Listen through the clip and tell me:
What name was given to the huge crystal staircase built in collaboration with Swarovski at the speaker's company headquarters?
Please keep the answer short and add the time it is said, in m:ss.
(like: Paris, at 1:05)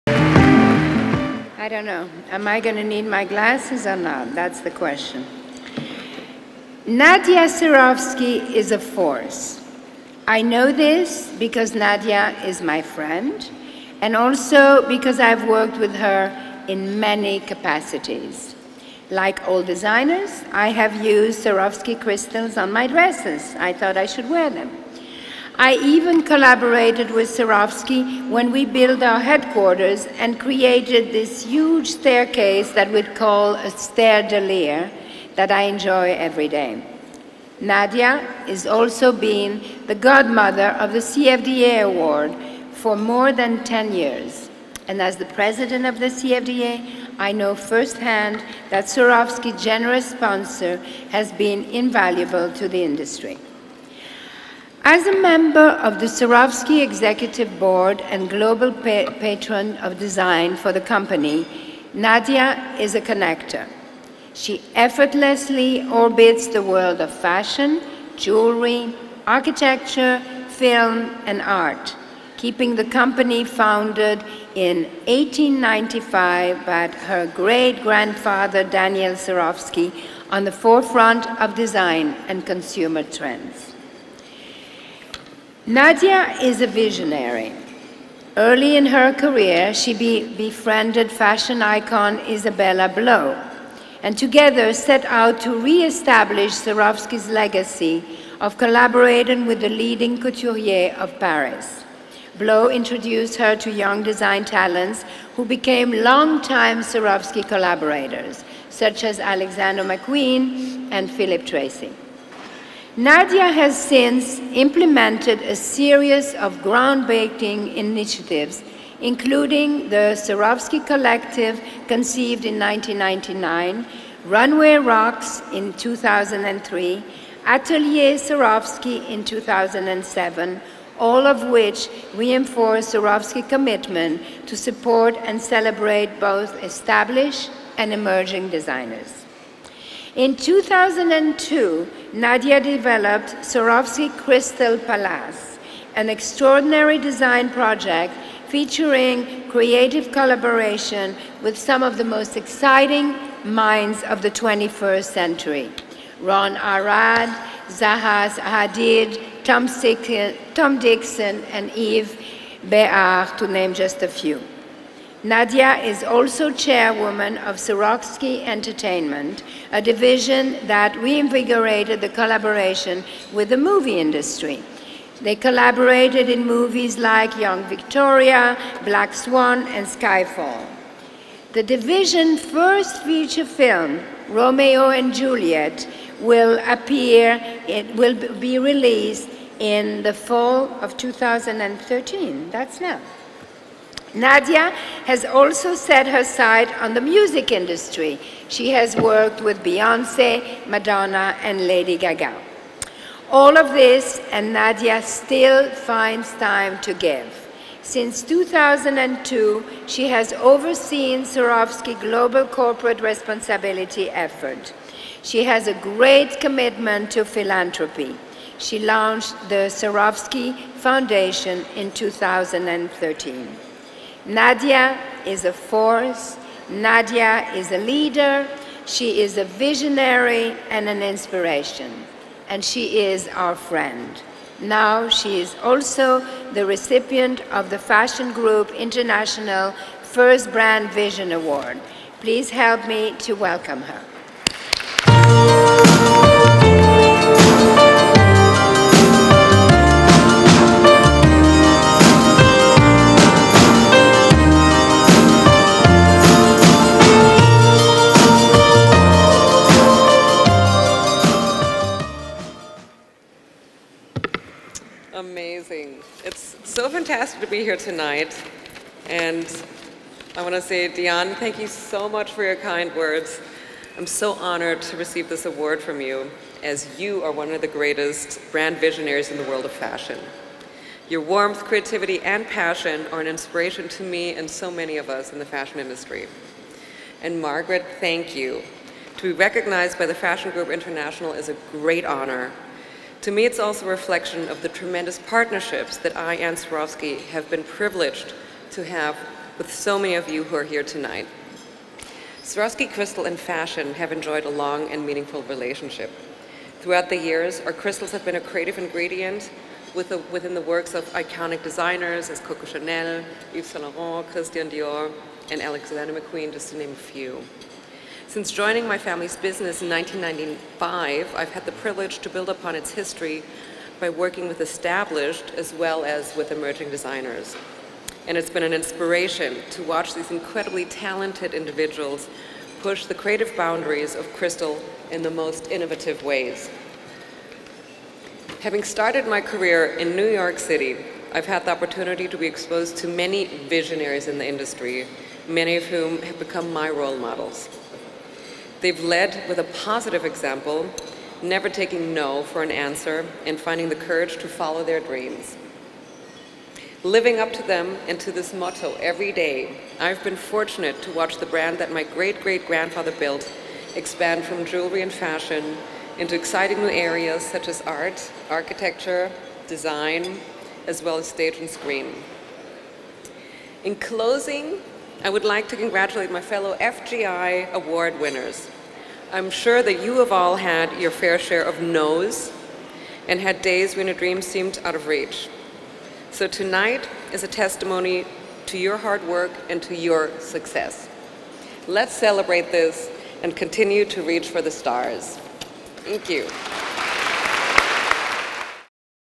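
Stairdelier, at 0:33.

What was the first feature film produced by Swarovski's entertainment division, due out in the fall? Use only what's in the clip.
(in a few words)
Romeo and Juliet.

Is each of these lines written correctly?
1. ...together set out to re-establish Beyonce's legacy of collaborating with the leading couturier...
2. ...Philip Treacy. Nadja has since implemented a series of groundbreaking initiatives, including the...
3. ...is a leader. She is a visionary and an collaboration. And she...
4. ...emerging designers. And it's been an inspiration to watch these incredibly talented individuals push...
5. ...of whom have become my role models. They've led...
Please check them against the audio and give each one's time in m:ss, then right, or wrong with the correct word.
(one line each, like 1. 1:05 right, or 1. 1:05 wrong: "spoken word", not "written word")
1. 1:34 wrong: "Swarovski", not "Beyonce"
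2. 1:51 right
3. 3:47 wrong: "inspiration", not "collaboration"
4. 5:26 right
5. 5:45 right.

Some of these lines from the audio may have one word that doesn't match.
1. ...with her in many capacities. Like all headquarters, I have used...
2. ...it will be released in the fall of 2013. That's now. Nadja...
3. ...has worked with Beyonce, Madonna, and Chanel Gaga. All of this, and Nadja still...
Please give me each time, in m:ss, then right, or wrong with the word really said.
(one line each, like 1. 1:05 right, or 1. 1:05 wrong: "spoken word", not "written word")
1. 0:15 wrong: "designers", not "headquarters"
2. 3:07 right
3. 3:18 wrong: "Lady", not "Chanel".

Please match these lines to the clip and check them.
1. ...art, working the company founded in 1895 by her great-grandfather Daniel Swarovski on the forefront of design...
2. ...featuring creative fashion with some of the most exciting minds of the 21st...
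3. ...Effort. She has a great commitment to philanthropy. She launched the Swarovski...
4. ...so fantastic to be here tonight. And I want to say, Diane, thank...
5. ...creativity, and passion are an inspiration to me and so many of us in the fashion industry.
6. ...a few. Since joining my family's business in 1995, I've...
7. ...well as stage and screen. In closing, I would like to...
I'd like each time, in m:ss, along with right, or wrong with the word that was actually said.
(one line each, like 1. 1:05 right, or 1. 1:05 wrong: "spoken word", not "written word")
1. 1:11 wrong: "keeping", not "working"
2. 2:28 wrong: "collaboration", not "fashion"
3. 3:34 right
4. 4:26 right
5. 4:41 right
6. 5:16 right
7. 6:11 right.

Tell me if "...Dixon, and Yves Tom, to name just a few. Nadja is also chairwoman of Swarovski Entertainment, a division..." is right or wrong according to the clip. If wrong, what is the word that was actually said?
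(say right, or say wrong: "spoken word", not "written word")
wrong: "Béhar", not "Tom".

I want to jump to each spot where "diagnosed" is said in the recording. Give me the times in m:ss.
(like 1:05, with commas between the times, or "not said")
not said.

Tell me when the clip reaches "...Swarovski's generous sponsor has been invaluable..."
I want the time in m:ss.
0:48.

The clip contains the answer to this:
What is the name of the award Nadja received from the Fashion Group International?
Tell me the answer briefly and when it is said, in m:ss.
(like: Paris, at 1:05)
First Brand Vision Award, at 4:00.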